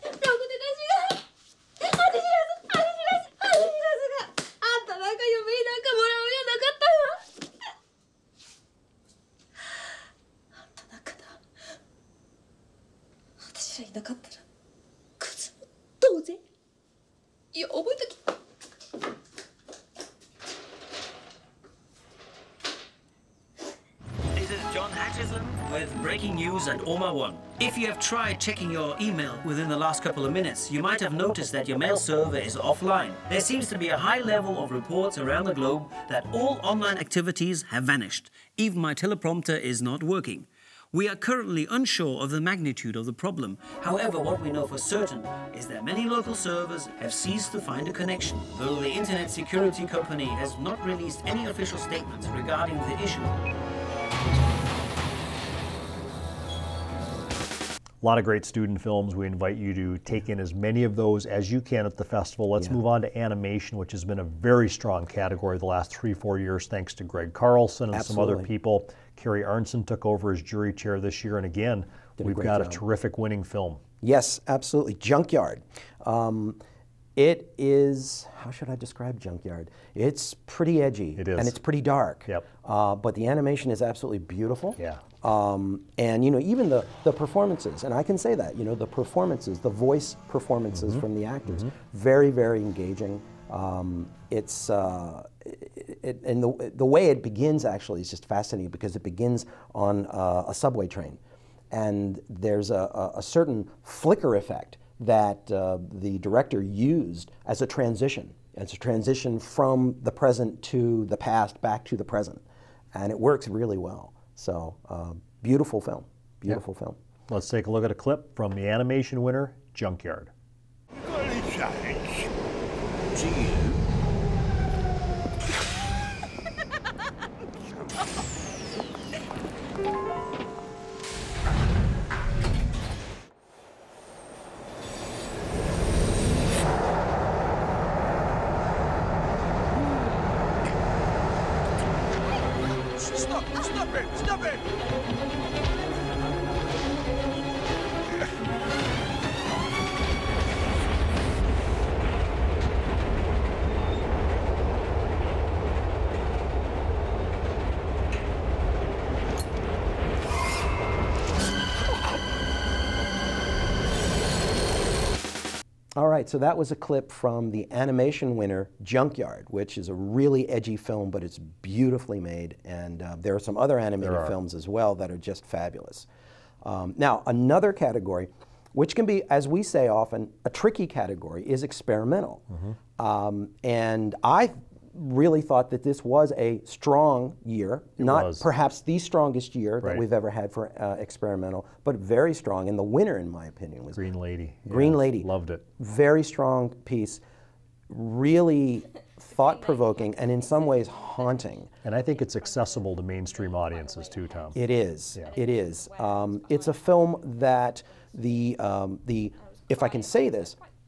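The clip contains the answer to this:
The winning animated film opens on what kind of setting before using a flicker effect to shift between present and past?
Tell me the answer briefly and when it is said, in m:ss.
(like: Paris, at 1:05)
A subway train, at 1:40.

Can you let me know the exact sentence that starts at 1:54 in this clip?
So um, beautiful film, beautiful film.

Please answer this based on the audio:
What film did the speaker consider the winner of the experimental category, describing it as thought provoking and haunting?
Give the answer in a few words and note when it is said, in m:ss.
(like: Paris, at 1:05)
Green Lady, at 3:13.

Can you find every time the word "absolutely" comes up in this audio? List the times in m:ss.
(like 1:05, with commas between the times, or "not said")
1:07, 1:14, 1:23.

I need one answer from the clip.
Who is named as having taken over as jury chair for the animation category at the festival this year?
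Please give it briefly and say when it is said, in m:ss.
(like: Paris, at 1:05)
Kerry Arnson, at 1:09.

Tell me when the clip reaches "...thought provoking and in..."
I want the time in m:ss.
3:19.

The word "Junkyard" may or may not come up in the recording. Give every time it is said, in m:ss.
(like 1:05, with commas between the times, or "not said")
1:14, 1:19, 1:59, 2:48.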